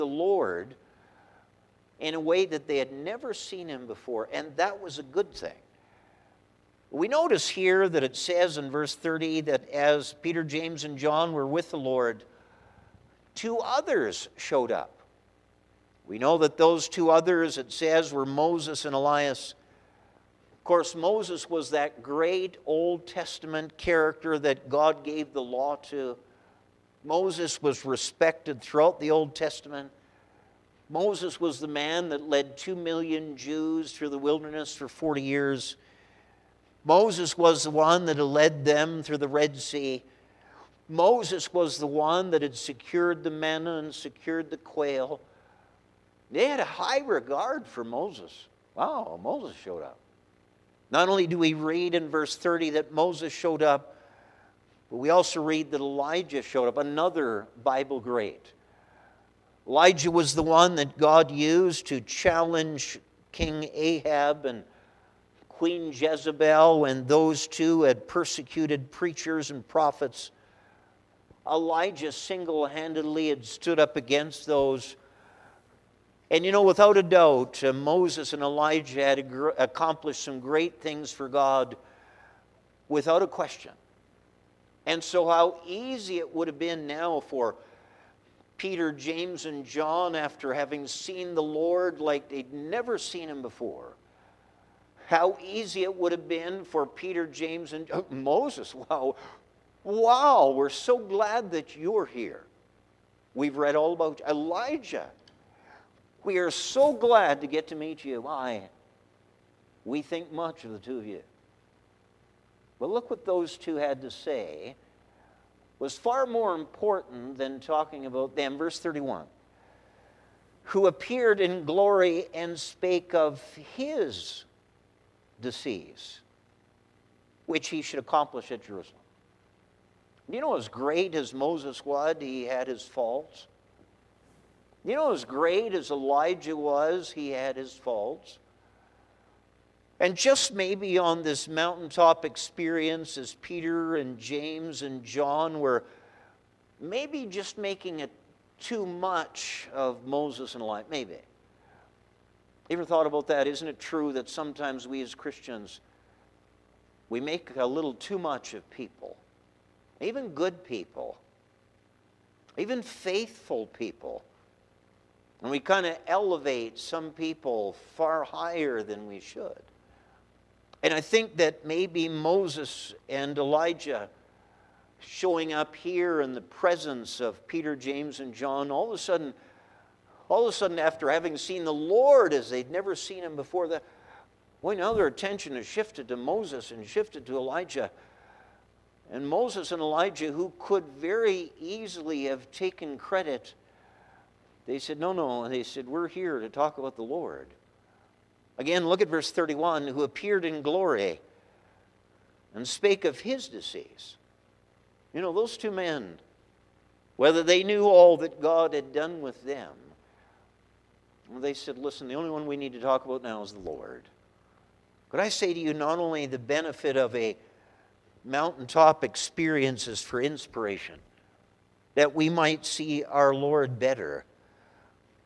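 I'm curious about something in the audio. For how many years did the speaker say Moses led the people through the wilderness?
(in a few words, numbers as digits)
40.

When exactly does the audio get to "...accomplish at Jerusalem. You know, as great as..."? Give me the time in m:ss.
2:07.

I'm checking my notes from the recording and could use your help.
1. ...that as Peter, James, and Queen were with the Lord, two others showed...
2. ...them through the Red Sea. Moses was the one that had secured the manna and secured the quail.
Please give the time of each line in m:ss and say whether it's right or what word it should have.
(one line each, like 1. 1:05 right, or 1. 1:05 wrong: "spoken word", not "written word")
1. 0:09 wrong: "John", not "Queen"
2. 0:38 right.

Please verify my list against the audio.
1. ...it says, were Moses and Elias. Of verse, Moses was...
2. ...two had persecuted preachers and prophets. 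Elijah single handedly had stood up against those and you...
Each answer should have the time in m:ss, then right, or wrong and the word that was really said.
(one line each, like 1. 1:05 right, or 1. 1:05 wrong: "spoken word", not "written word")
1. 0:17 wrong: "course", not "verse"
2. 1:07 right.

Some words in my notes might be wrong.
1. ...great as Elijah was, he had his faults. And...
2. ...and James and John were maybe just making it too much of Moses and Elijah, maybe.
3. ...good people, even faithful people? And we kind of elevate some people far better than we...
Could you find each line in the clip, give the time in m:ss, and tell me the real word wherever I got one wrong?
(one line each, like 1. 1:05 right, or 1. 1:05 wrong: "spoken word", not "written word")
1. 2:15 right
2. 2:23 right
3. 2:40 wrong: "higher", not "better".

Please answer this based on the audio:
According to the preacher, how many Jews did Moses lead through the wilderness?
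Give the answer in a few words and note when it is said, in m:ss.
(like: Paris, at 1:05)
2 million, at 0:32.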